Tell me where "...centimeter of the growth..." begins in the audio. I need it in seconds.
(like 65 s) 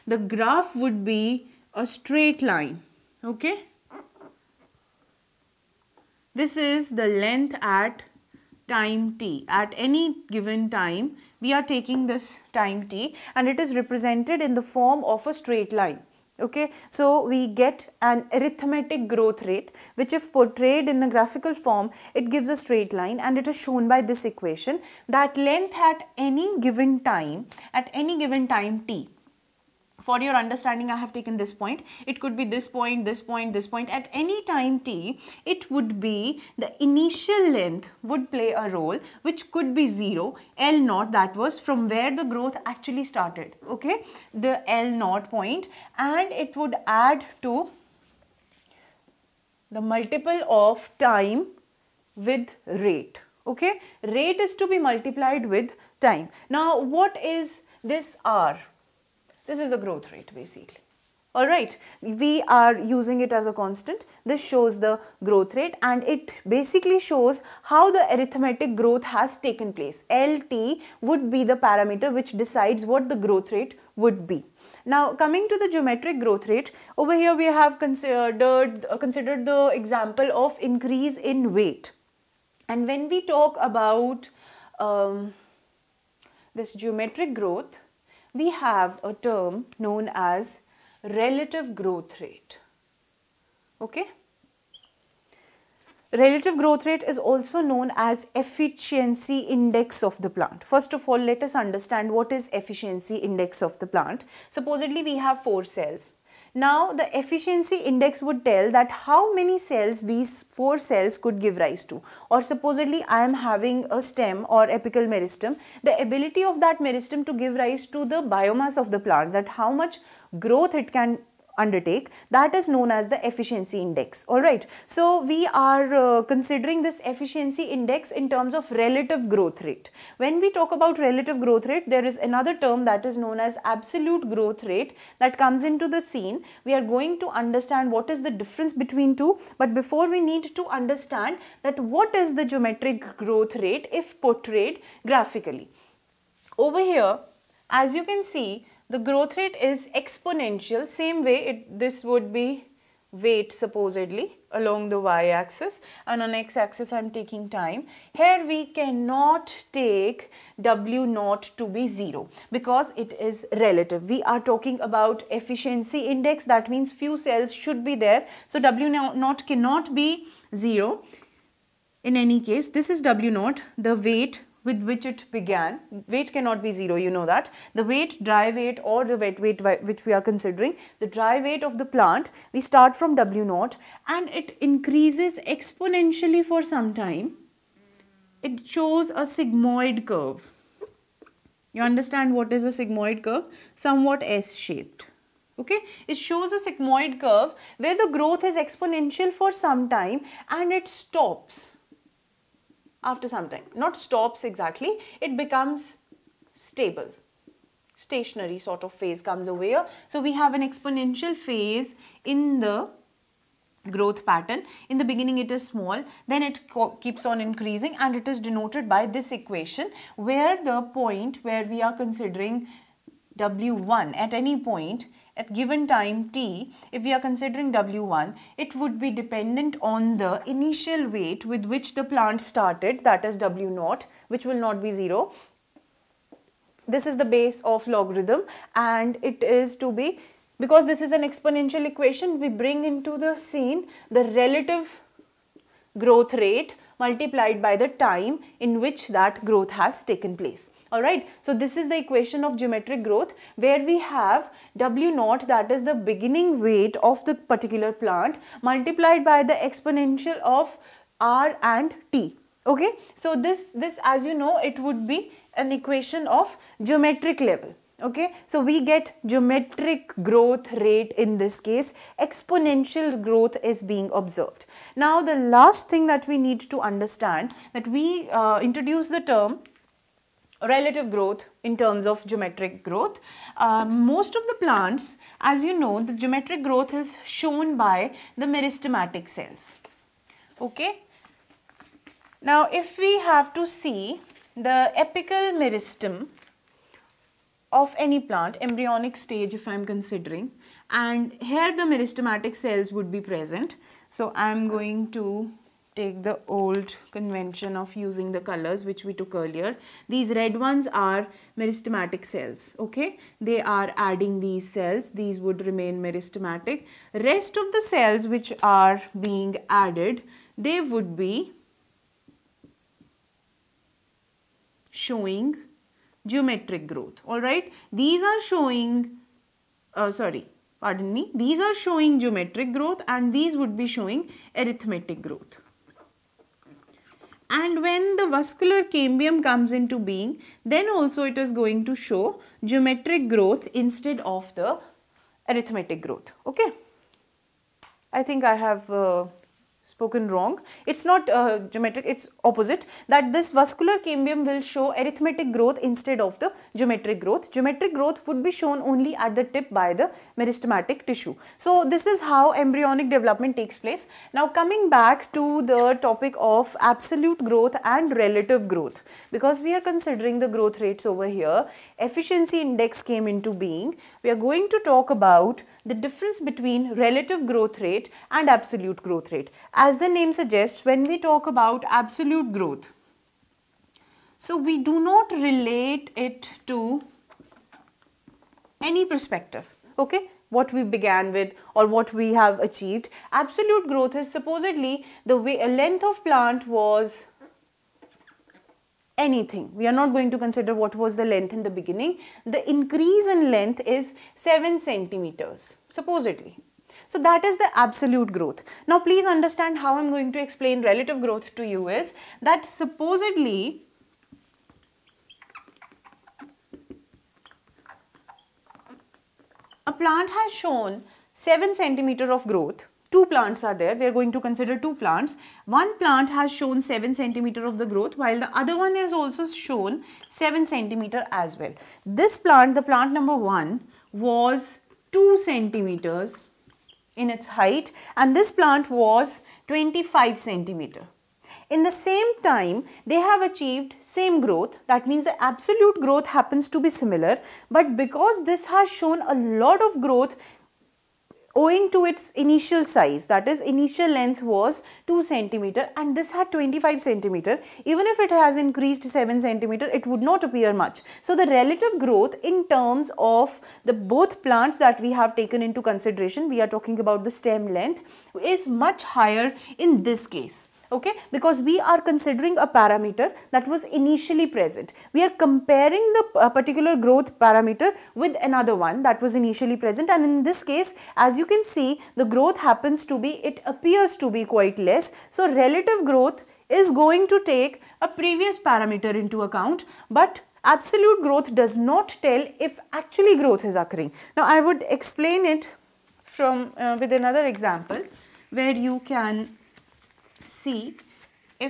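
427 s.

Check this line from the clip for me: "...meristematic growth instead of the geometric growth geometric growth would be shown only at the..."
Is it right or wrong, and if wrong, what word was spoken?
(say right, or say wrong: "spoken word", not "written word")
wrong: "arithmetic", not "meristematic".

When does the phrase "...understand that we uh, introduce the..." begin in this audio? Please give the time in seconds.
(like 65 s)
276 s.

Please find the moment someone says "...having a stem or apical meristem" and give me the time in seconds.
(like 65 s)
113 s.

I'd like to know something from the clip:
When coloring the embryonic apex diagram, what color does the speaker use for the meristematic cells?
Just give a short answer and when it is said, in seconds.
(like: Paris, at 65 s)
Red, at 310 s.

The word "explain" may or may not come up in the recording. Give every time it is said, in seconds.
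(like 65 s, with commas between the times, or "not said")
410 s, 494 s.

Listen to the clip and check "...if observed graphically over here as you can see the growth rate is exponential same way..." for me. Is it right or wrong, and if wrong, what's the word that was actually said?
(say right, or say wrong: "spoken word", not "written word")
wrong: "portrayed", not "observed".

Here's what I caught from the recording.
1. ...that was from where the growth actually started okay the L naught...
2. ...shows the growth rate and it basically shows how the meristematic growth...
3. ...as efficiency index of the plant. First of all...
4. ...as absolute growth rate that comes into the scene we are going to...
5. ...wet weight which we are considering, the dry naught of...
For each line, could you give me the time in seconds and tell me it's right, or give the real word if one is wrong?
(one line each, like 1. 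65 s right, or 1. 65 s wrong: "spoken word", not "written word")
1. 41 s right
2. 64 s wrong: "arithmetic", not "meristematic"
3. 97 s right
4. 133 s right
5. 179 s wrong: "weight", not "naught".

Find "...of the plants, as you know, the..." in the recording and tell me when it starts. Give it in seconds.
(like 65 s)
284 s.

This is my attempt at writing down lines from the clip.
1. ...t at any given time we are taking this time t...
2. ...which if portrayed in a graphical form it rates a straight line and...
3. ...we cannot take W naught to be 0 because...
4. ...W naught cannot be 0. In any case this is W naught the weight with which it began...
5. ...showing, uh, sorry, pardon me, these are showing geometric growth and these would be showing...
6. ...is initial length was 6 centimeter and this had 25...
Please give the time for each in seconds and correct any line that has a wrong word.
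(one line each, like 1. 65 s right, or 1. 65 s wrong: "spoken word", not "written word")
1. 9 s right
2. 19 s wrong: "gives", not "rates"
3. 158 s right
4. 168 s right
5. 328 s right
6. 453 s wrong: "2", not "6".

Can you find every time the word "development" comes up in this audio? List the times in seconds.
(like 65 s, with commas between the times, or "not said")
363 s.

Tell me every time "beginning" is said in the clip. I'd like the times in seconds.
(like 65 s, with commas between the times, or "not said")
215 s, 255 s, 401 s.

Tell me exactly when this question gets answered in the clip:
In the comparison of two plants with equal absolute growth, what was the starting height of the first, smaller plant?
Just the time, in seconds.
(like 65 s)
435 s.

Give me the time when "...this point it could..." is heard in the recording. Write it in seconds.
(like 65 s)
31 s.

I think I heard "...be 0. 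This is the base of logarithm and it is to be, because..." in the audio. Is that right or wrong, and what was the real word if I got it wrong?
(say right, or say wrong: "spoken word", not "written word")
right.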